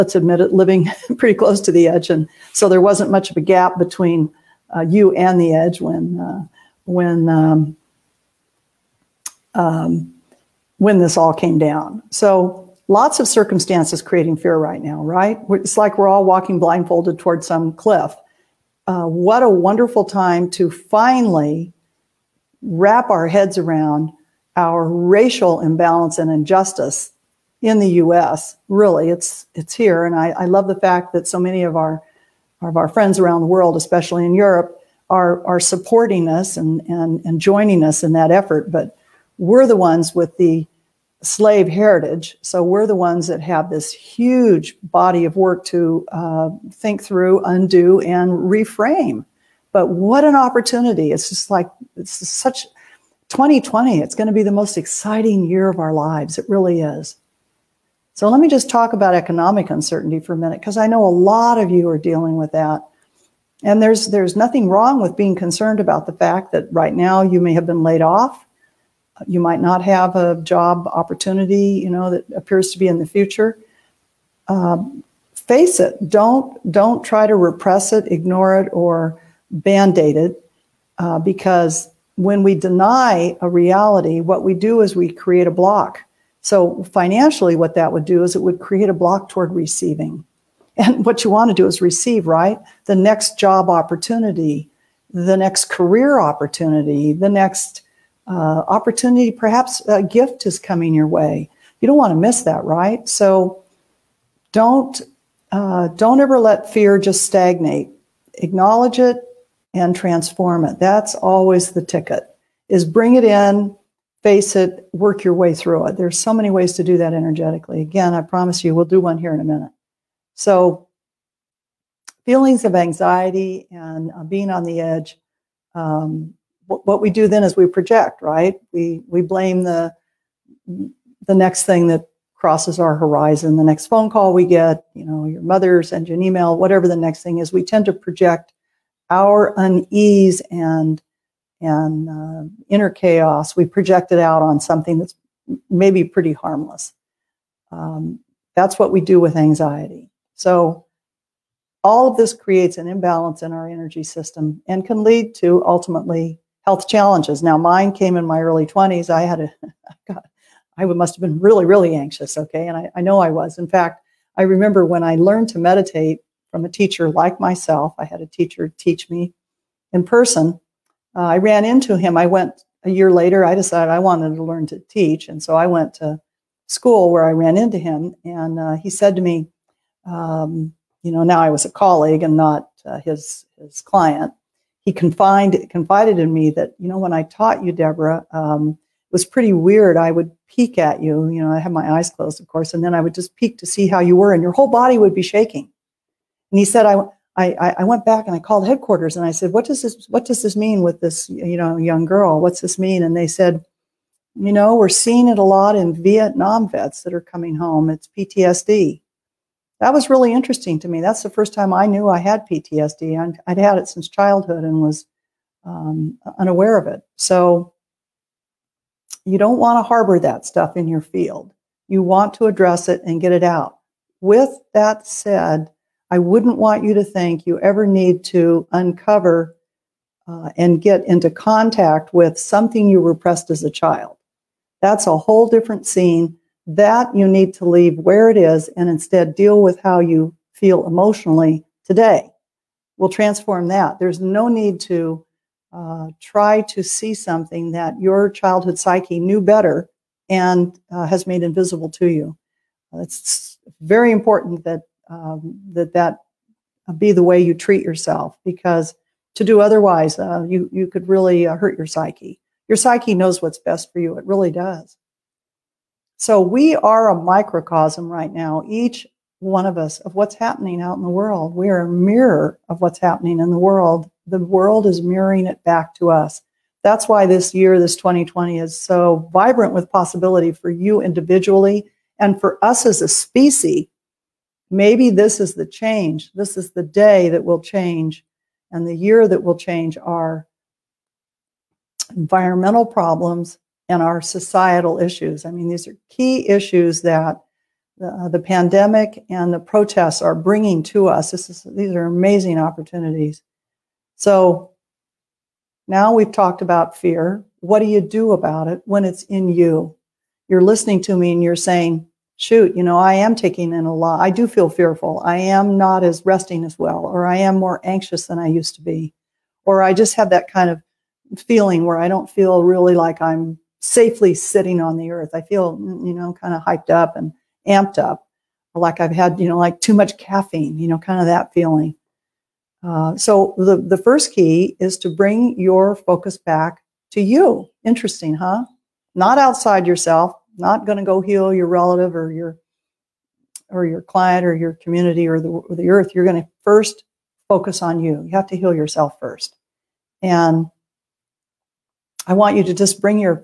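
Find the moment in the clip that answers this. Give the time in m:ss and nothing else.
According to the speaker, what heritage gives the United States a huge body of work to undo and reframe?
0:41.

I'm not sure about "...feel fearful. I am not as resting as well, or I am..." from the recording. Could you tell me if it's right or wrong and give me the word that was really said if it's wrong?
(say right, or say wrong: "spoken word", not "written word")
right.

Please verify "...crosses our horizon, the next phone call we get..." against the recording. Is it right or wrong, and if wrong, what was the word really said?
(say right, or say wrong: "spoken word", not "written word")
right.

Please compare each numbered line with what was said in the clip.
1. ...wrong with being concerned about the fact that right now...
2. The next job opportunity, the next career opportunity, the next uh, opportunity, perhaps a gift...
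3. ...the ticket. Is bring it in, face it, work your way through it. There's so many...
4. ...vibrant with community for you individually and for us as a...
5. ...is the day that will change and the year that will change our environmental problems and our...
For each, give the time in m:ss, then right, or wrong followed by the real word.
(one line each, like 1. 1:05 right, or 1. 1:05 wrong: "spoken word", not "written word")
1. 1:04 right
2. 1:32 right
3. 1:51 right
4. 4:39 wrong: "possibility", not "community"
5. 4:46 right.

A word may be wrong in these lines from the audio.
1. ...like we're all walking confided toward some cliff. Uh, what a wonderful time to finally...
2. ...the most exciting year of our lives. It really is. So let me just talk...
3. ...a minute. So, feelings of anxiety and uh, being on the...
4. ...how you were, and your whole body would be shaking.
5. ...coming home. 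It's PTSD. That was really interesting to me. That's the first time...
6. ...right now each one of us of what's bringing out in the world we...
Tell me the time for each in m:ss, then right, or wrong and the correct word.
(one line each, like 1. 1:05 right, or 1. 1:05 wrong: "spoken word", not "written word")
1. 0:15 wrong: "blindfolded", not "confided"
2. 0:54 right
3. 1:59 right
4. 3:13 right
5. 3:27 right
6. 4:28 wrong: "happening", not "bringing".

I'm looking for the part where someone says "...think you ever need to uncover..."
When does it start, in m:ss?
3:47.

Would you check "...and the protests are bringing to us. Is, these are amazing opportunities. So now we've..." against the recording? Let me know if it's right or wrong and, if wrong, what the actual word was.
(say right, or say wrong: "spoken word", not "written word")
right.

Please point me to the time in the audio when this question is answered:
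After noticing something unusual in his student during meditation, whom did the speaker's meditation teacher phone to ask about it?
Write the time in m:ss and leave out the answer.
3:18.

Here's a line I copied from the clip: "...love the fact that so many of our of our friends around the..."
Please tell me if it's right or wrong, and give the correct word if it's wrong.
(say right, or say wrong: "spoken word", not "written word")
right.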